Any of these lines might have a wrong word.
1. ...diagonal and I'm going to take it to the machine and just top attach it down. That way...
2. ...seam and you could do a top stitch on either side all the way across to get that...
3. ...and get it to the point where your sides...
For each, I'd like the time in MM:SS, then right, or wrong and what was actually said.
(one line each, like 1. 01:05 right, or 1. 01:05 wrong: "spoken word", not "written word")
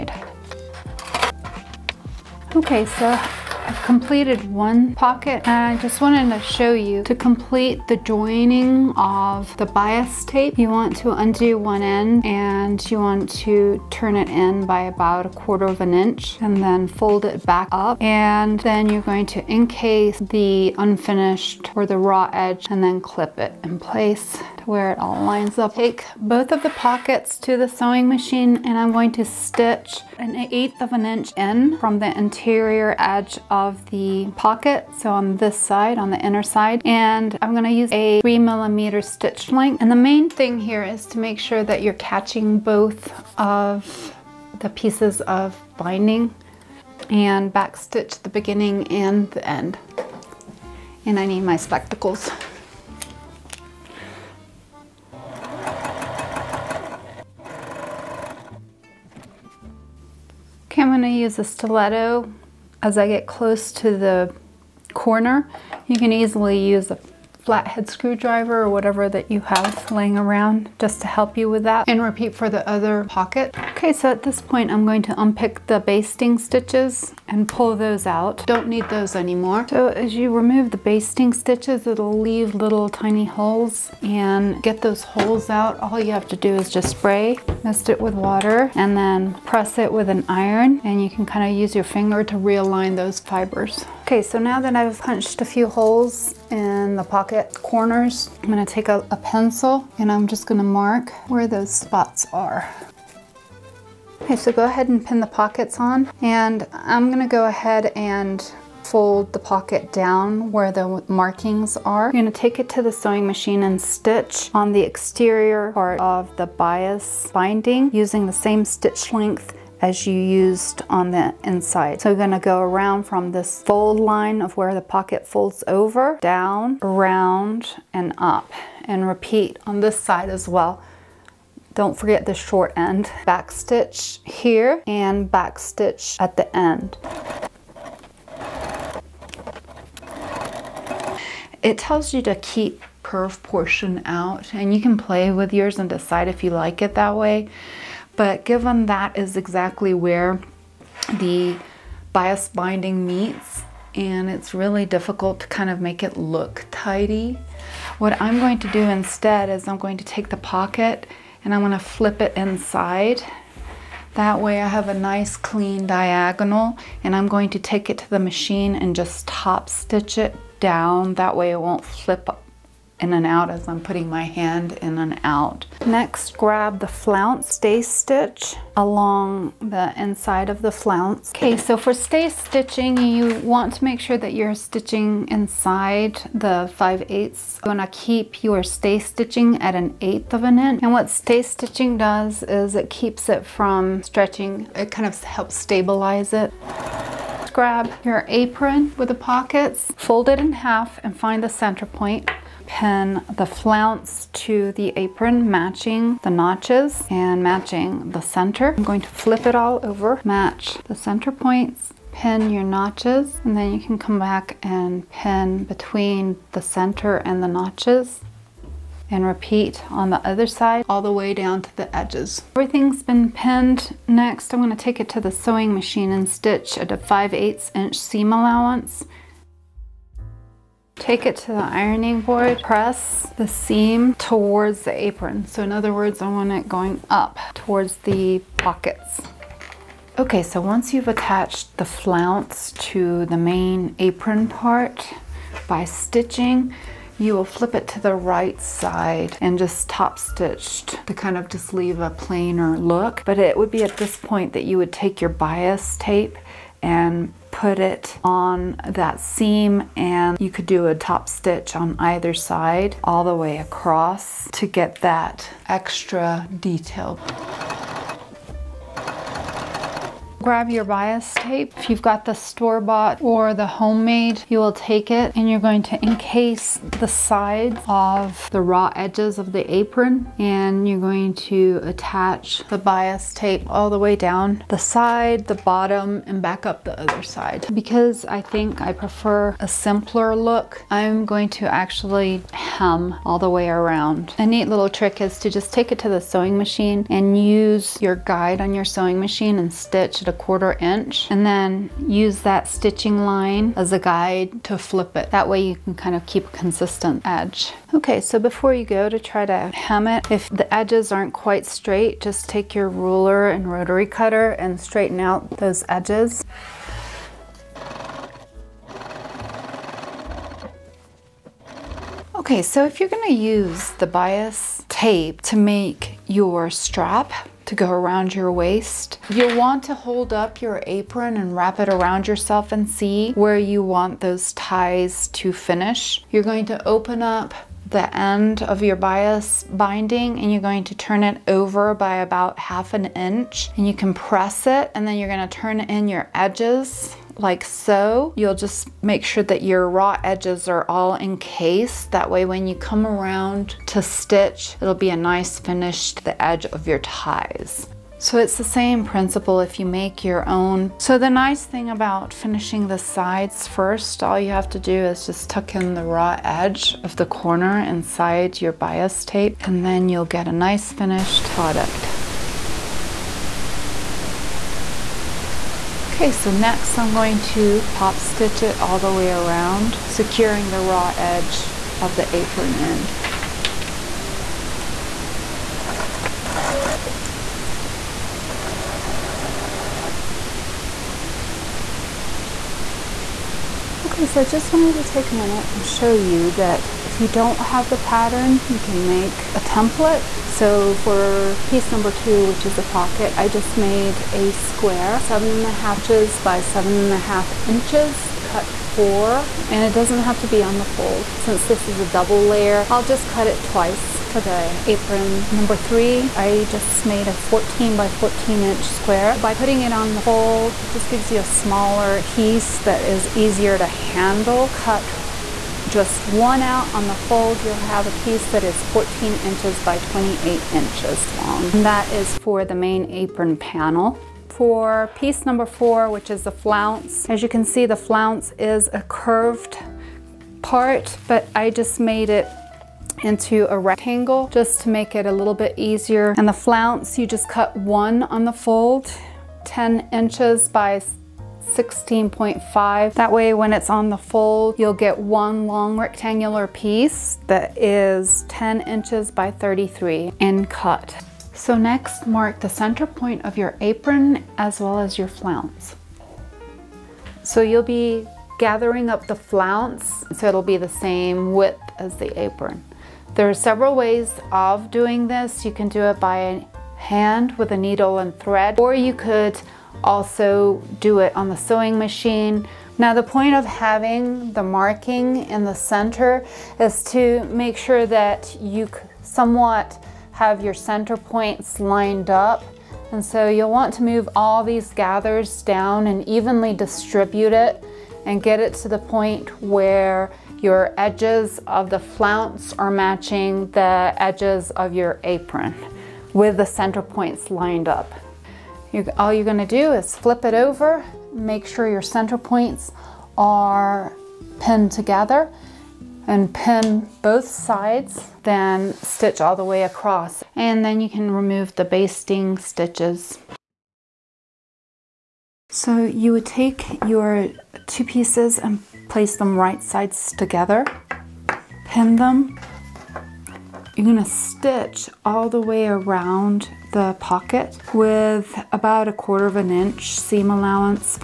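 1. 02:45 wrong: "stitch", not "attach"
2. 04:19 right
3. 08:18 wrong: "edges", not "sides".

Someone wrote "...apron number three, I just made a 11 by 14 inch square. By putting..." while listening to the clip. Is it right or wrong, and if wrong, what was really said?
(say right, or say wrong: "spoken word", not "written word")
wrong: "14", not "11".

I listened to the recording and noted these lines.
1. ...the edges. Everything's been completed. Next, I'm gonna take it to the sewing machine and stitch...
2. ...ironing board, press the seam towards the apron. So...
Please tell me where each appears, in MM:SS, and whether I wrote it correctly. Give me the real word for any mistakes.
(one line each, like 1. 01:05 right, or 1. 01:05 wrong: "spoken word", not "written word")
1. 03:41 wrong: "pinned", not "completed"
2. 03:51 right.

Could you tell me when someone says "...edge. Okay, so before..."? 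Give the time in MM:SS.
05:07.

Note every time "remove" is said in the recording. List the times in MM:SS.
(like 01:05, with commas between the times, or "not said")
01:20, 08:41.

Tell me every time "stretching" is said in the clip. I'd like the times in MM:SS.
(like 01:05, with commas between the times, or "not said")
03:14.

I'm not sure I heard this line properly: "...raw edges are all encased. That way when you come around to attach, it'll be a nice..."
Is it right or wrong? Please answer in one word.
wrong.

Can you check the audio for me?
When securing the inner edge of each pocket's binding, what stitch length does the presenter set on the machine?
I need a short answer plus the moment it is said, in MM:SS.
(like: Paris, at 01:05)
3 millimeter, at 00:38.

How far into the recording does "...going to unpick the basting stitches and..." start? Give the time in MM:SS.
01:14.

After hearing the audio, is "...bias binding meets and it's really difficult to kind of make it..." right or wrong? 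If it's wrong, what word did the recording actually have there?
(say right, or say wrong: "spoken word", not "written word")
right.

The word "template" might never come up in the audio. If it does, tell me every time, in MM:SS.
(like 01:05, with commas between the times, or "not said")
06:39.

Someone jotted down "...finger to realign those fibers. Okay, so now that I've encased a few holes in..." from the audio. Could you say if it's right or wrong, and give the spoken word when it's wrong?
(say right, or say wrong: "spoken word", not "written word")
wrong: "punched", not "encased".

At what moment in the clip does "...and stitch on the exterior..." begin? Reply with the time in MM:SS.
01:53.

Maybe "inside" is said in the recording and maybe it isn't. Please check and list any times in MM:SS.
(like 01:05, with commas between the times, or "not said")
02:01, 02:42, 02:59, 03:05, 06:07.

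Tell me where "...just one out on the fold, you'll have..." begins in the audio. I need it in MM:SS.
07:05.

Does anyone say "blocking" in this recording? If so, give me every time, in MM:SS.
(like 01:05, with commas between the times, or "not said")
not said.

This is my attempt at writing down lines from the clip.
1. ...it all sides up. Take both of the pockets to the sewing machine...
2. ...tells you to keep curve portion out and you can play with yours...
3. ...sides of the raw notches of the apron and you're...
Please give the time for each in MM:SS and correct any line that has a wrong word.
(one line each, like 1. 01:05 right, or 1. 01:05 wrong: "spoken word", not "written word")
1. 00:24 wrong: "lines", not "sides"
2. 02:21 right
3. 04:37 wrong: "edges", not "notches".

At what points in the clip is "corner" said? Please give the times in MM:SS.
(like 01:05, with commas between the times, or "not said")
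01:04, 01:37, 06:07.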